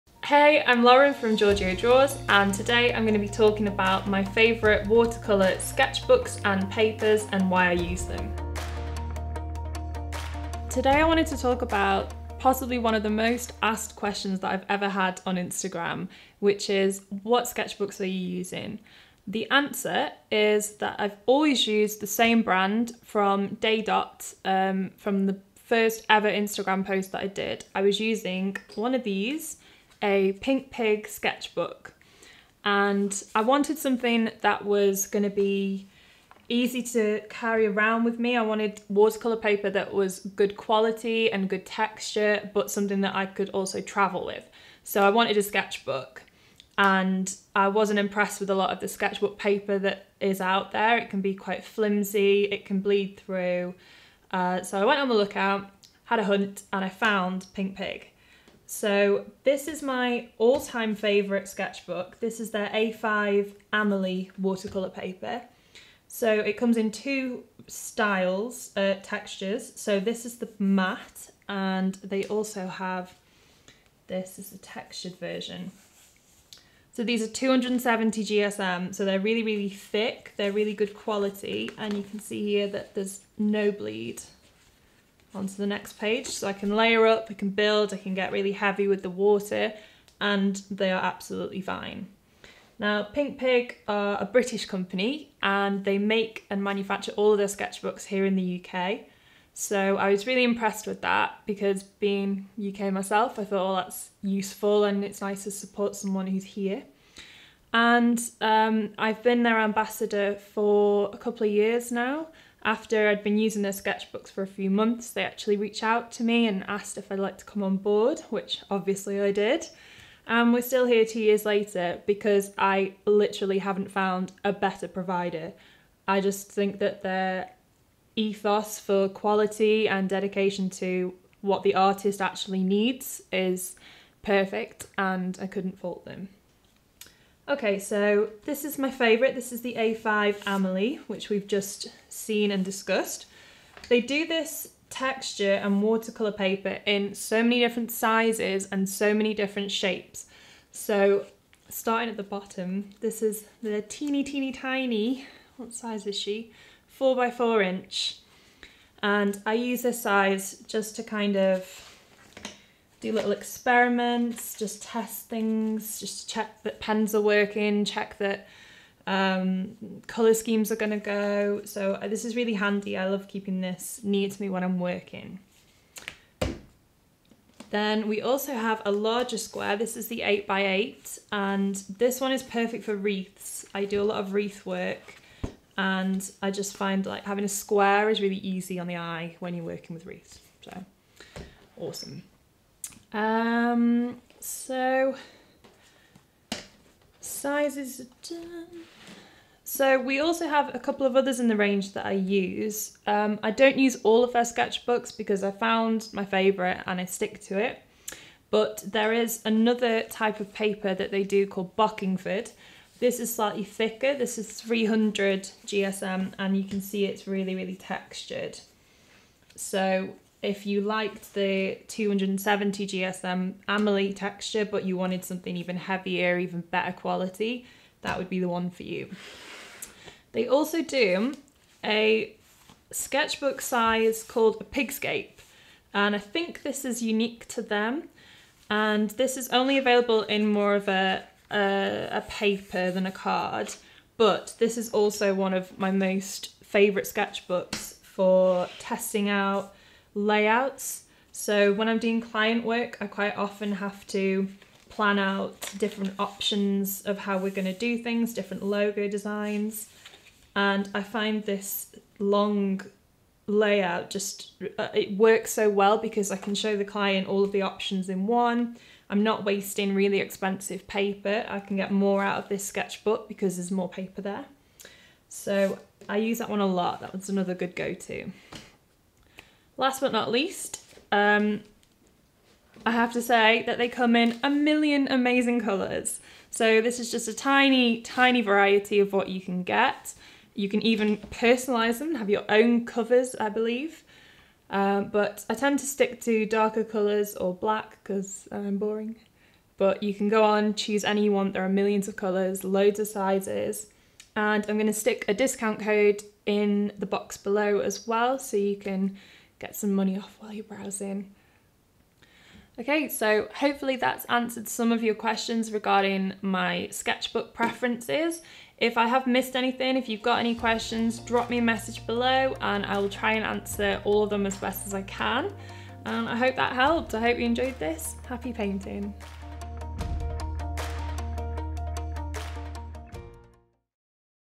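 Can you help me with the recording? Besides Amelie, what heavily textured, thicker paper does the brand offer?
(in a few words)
Bockingford.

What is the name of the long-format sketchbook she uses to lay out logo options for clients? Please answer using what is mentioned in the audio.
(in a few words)
Pigscape.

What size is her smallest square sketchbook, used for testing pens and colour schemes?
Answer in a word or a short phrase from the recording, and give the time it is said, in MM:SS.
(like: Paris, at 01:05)
4 by 4 inch, at 02:36.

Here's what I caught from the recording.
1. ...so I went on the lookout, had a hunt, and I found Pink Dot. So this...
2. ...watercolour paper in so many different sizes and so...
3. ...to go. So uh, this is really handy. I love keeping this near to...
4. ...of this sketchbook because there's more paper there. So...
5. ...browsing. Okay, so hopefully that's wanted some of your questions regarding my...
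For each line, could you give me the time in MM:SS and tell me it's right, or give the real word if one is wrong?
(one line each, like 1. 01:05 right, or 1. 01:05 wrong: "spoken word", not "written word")
1. 00:54 wrong: "Pig", not "Dot"
2. 02:25 right
3. 02:50 right
4. 04:32 right
5. 05:10 wrong: "answered", not "wanted".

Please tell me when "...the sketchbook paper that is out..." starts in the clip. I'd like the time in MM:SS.
00:48.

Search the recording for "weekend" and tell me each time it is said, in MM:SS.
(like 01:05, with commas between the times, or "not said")
not said.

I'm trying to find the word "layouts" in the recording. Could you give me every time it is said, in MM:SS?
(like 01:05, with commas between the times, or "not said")
04:10, 04:23.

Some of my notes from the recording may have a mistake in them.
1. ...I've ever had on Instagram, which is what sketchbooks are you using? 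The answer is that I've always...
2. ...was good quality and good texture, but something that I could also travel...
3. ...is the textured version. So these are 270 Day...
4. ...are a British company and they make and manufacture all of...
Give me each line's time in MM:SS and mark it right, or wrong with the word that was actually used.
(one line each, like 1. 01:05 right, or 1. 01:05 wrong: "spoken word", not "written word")
1. 00:14 right
2. 00:39 right
3. 01:14 wrong: "GSM", not "Day"
4. 01:33 right.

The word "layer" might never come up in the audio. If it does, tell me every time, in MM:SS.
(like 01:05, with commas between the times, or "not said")
01:26.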